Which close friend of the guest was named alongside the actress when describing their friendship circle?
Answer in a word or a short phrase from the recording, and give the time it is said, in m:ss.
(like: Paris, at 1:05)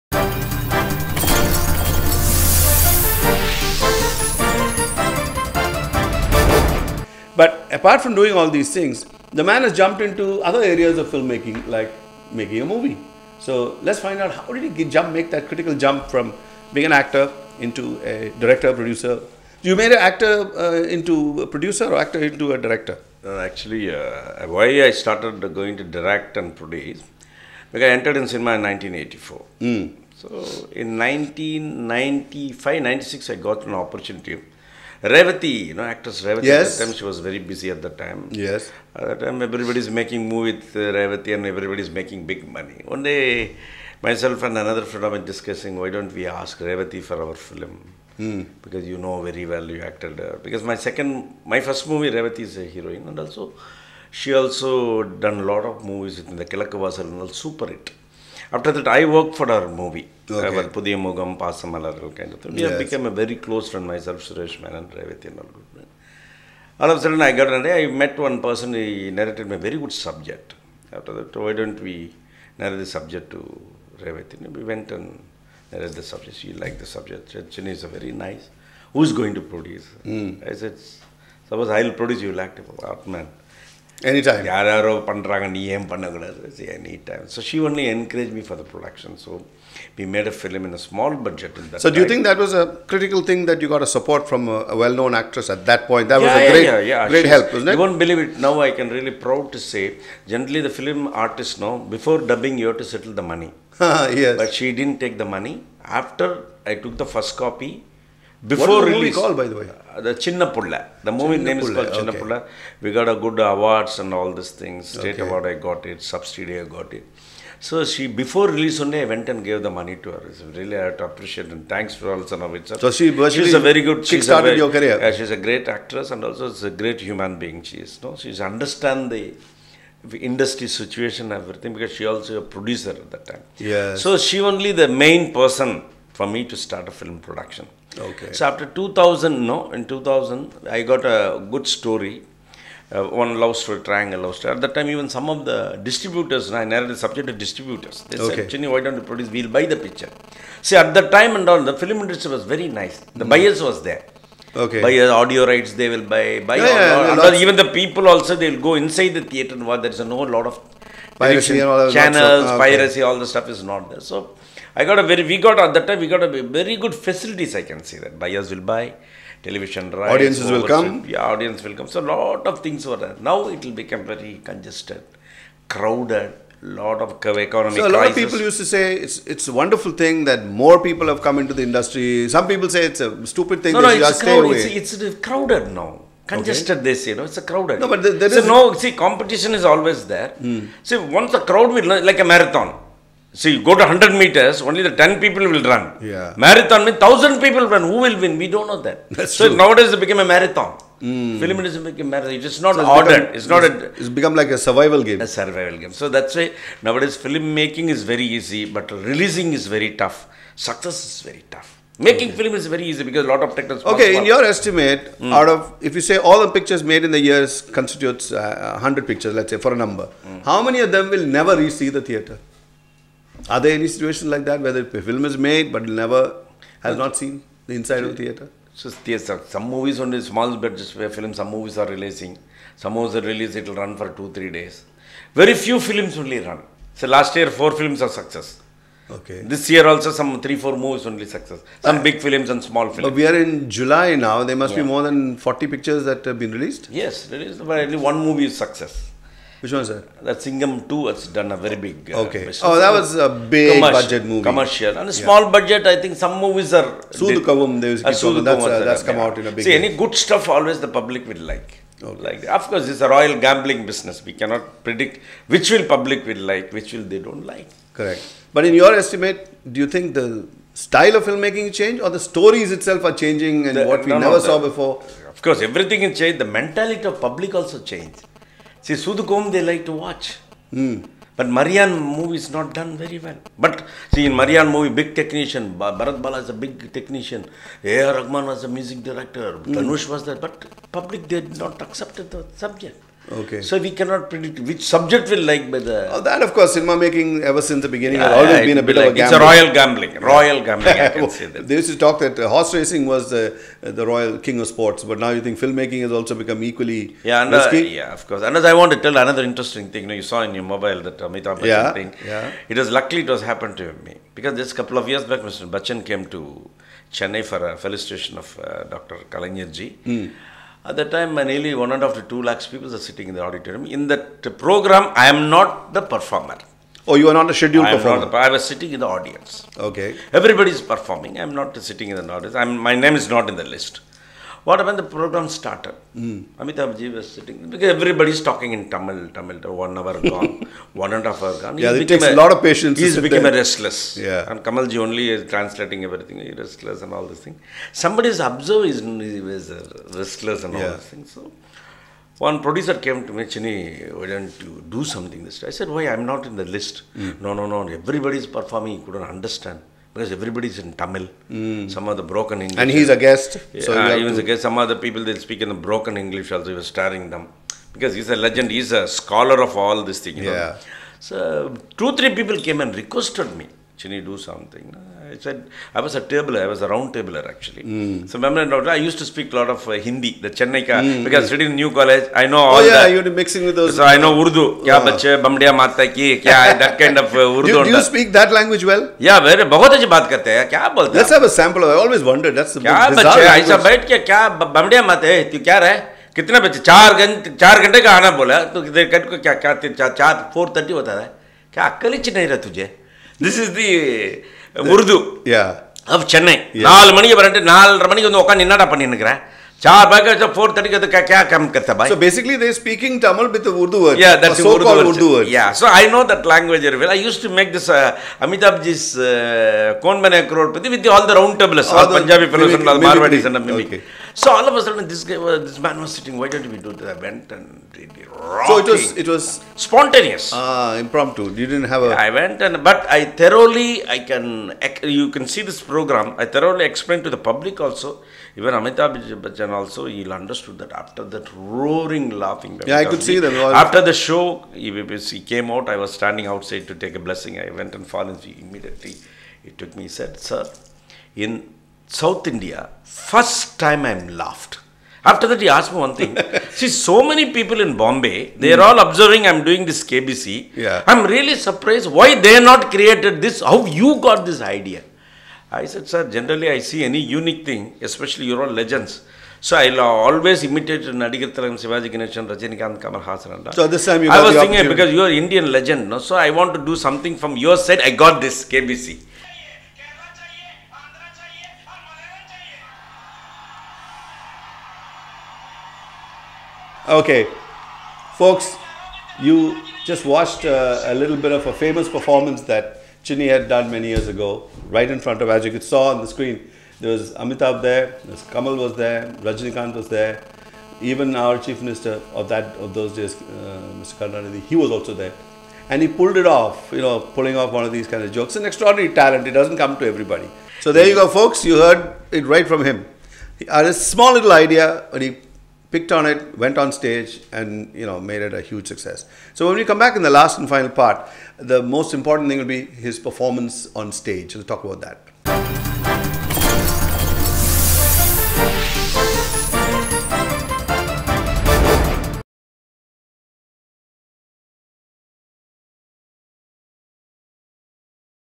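Suresh Menon, at 1:04.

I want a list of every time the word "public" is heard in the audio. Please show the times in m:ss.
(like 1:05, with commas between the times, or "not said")
4:20, 4:25, 4:37, 4:50, 7:17.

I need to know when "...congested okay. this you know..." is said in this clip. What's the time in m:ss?
3:06.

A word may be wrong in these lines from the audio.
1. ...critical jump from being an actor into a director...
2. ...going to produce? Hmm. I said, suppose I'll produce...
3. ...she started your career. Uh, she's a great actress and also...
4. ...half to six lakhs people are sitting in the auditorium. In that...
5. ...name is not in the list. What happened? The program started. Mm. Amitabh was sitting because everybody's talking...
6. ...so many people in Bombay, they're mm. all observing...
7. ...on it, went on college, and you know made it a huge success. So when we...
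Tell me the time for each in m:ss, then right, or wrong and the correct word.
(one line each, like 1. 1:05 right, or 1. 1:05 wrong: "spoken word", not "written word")
1. 0:15 right
2. 1:19 right
3. 2:04 right
4. 5:22 wrong: "two", not "six"
5. 5:32 right
6. 7:36 right
7. 8:36 wrong: "stage", not "college".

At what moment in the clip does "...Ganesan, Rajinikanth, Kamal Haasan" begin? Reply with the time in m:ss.
7:52.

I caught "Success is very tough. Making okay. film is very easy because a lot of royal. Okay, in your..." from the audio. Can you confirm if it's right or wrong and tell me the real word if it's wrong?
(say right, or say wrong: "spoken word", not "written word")
wrong: "technical", not "royal".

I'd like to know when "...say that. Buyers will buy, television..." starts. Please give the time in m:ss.
2:47.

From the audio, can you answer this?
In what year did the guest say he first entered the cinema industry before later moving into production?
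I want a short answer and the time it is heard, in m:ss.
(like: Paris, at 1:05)
1984, at 0:28.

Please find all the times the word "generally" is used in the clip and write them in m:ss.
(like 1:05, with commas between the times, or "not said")
1:40, 7:46.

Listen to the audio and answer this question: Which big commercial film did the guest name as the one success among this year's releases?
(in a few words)
Singham 2.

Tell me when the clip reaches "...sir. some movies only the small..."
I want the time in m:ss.
3:49.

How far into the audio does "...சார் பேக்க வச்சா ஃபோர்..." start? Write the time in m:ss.
6:49.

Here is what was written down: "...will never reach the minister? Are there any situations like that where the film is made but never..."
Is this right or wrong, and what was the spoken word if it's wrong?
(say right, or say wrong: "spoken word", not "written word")
wrong: "theater", not "minister".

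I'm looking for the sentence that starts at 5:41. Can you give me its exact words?
yeah, it takes a, lot of patience.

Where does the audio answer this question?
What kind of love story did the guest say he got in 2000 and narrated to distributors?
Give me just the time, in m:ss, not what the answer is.
2:23.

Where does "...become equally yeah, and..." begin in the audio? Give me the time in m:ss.
5:06.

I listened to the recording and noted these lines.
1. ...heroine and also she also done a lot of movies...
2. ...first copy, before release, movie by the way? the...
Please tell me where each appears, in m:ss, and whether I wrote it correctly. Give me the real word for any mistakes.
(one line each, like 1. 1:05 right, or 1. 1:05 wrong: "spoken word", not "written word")
1. 0:52 right
2. 1:47 right.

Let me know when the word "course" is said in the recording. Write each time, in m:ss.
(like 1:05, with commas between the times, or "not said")
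4:22, 4:35, 4:56, 5:08.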